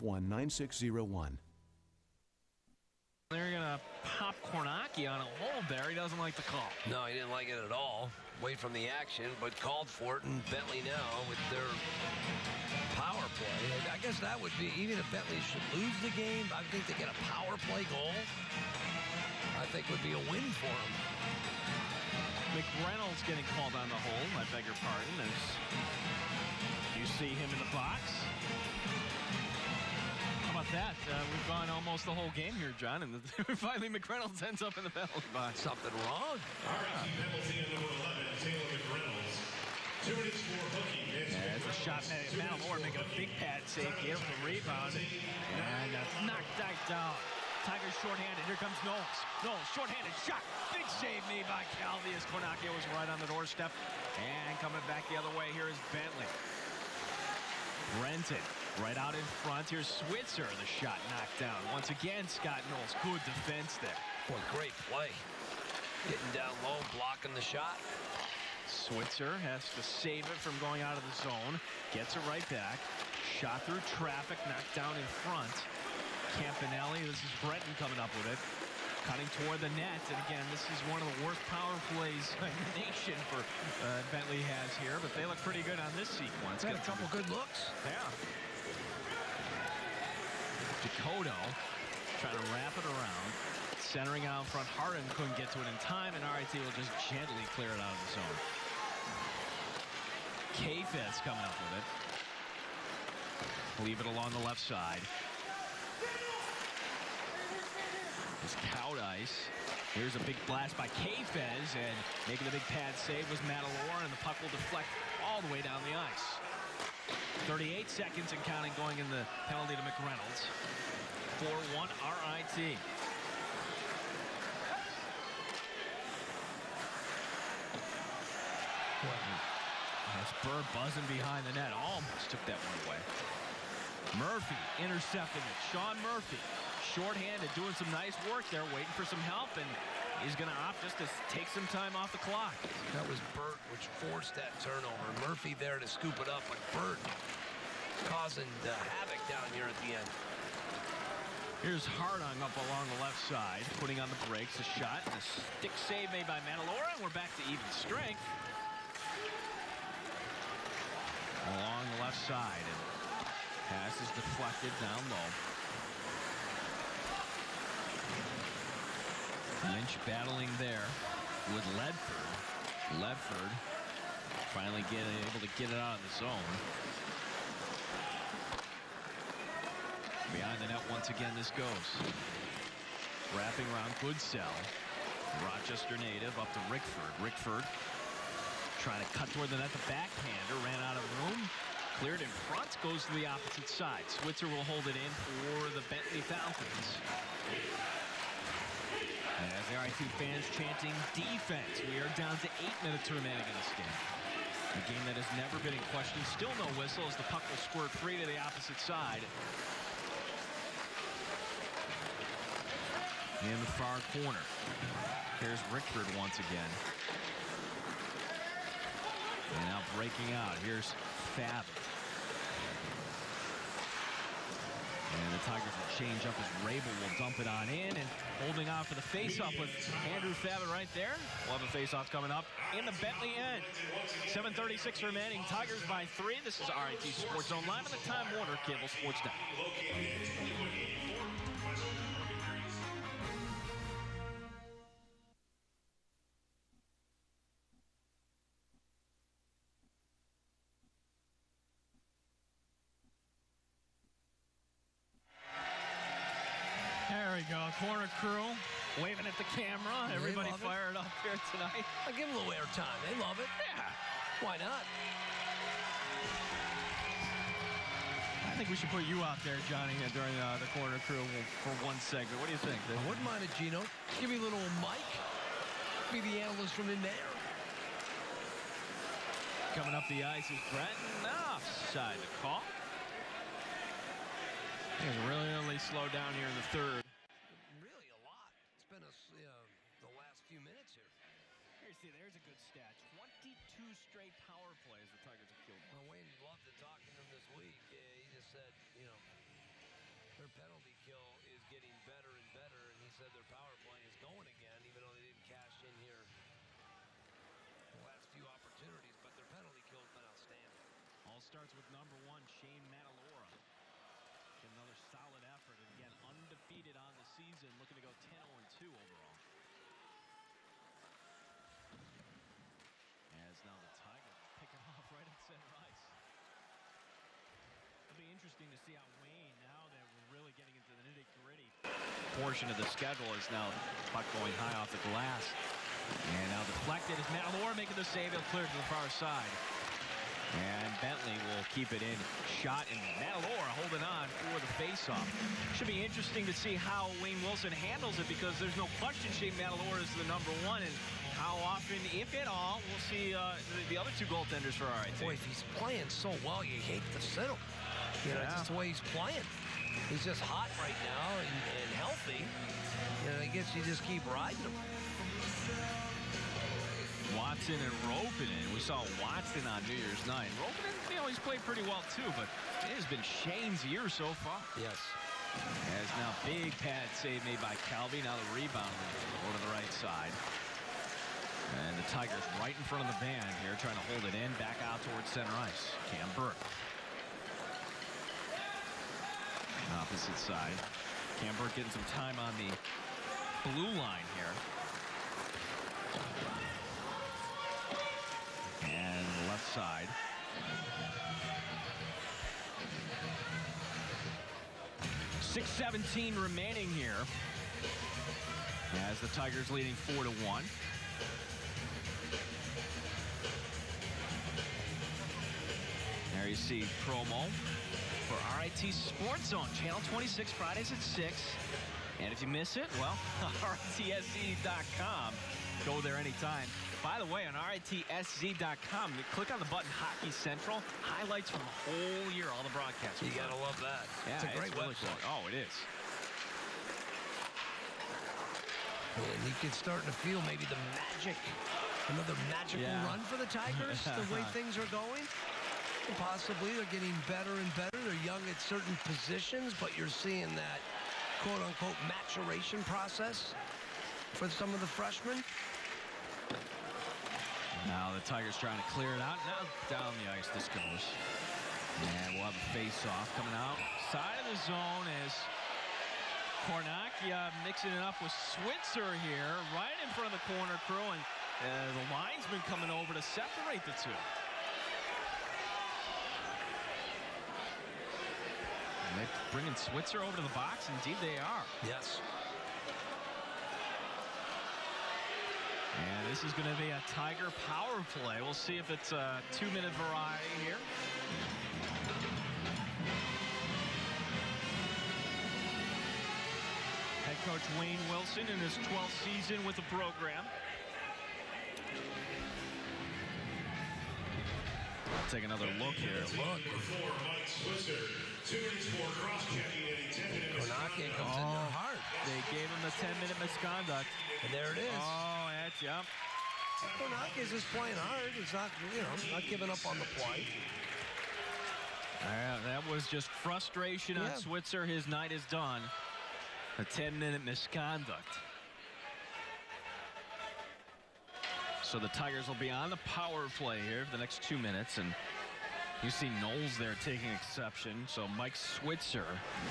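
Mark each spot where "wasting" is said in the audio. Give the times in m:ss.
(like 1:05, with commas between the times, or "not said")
not said.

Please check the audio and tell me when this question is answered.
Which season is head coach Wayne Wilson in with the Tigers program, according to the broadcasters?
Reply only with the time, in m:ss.
8:18.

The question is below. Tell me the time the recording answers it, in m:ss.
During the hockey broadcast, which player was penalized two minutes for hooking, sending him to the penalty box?
0:38.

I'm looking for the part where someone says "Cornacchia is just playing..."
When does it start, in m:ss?
8:36.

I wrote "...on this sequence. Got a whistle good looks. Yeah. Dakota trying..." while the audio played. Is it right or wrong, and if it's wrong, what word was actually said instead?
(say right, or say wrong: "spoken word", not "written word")
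wrong: "couple", not "whistle".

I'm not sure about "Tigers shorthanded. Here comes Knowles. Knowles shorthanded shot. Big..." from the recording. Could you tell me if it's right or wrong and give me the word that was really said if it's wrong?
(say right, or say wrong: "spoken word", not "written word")
right.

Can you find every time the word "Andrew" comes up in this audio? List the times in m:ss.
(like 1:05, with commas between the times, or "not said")
3:50.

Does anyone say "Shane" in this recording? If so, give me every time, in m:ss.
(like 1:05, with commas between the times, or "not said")
5:12, 5:49, 6:13.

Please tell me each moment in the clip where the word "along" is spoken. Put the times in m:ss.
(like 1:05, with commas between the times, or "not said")
1:44, 2:32, 2:41.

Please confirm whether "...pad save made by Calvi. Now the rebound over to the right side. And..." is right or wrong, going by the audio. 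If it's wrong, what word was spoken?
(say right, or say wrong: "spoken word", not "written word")
right.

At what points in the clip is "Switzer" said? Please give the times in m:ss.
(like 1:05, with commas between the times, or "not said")
0:59, 1:08, 3:14, 7:48, 7:59, 8:44, 8:58.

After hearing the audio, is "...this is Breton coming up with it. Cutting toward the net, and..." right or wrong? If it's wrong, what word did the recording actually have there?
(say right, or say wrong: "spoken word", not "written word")
right.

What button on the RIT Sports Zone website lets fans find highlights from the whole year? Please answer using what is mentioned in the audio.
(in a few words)
Hockey Central.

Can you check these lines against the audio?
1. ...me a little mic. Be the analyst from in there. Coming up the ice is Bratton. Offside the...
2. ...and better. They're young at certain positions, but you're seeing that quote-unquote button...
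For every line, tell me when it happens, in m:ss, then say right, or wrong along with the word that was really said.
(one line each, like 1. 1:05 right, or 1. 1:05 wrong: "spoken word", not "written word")
1. 4:34 right
2. 7:27 wrong: "maturation", not "button".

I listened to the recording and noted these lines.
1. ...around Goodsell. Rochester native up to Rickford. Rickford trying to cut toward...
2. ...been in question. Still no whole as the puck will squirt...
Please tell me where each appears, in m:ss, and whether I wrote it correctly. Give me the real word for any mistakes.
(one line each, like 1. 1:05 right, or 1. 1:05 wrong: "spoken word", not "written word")
1. 3:03 right
2. 3:25 wrong: "whistle", not "whole".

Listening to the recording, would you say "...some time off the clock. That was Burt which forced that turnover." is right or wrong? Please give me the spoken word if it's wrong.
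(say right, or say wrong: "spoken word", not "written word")
right.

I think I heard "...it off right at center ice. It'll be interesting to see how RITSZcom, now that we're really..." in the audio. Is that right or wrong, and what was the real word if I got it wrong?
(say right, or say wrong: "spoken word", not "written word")
wrong: "Wayne", not "RITSZcom".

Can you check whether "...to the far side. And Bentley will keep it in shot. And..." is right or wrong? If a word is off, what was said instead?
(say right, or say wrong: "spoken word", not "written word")
right.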